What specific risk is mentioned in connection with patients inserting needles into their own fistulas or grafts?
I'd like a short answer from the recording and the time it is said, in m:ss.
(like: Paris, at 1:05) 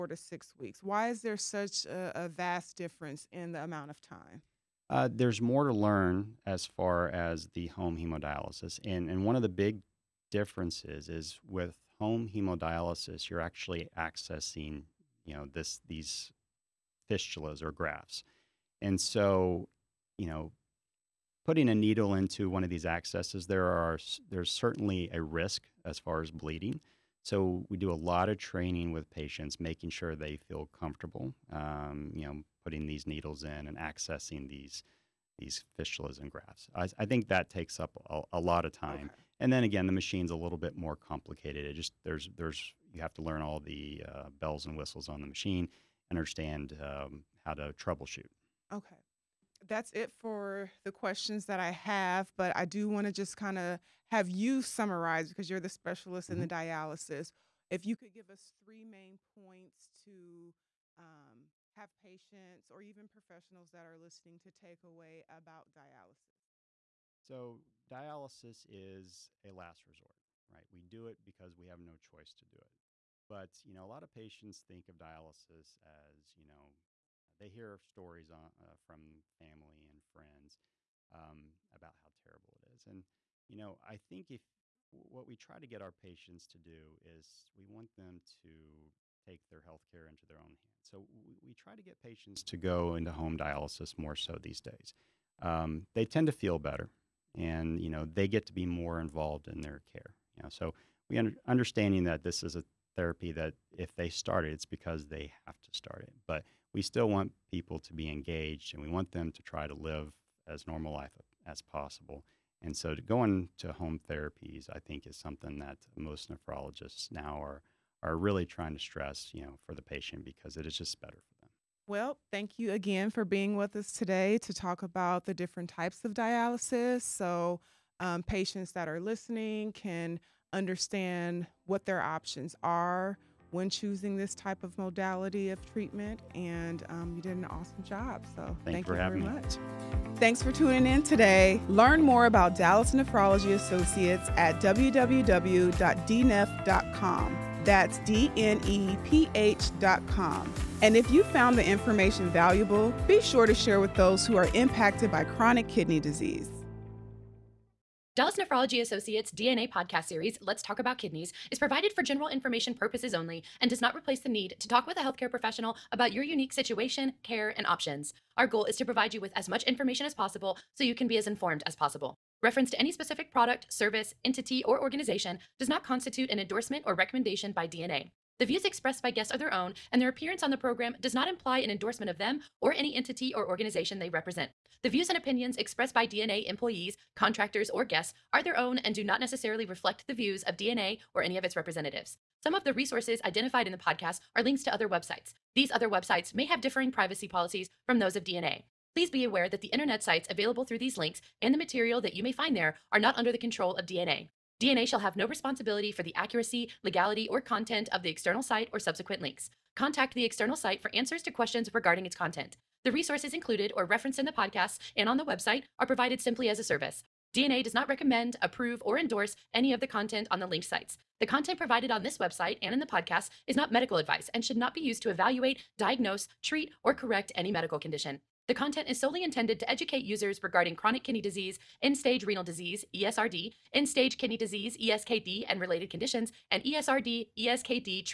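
Bleeding, at 0:26.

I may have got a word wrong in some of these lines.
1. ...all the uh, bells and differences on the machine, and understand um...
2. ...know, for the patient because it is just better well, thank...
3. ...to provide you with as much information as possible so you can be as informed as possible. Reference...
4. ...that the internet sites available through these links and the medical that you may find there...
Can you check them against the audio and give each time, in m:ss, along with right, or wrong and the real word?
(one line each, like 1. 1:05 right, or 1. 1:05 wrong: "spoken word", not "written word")
1. 0:43 wrong: "whistles", not "differences"
2. 1:59 right
3. 2:48 right
4. 3:19 wrong: "material", not "medical".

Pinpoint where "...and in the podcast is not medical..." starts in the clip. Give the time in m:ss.
3:42.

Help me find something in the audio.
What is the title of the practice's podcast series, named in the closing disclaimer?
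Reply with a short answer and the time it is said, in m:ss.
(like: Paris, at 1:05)
Let's Talk About Kidneys, at 2:40.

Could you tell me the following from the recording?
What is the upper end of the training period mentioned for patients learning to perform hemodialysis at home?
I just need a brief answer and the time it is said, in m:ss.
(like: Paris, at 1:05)
6 weeks, at 0:00.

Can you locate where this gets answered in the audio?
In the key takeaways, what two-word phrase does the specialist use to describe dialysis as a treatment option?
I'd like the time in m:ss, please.
1:09.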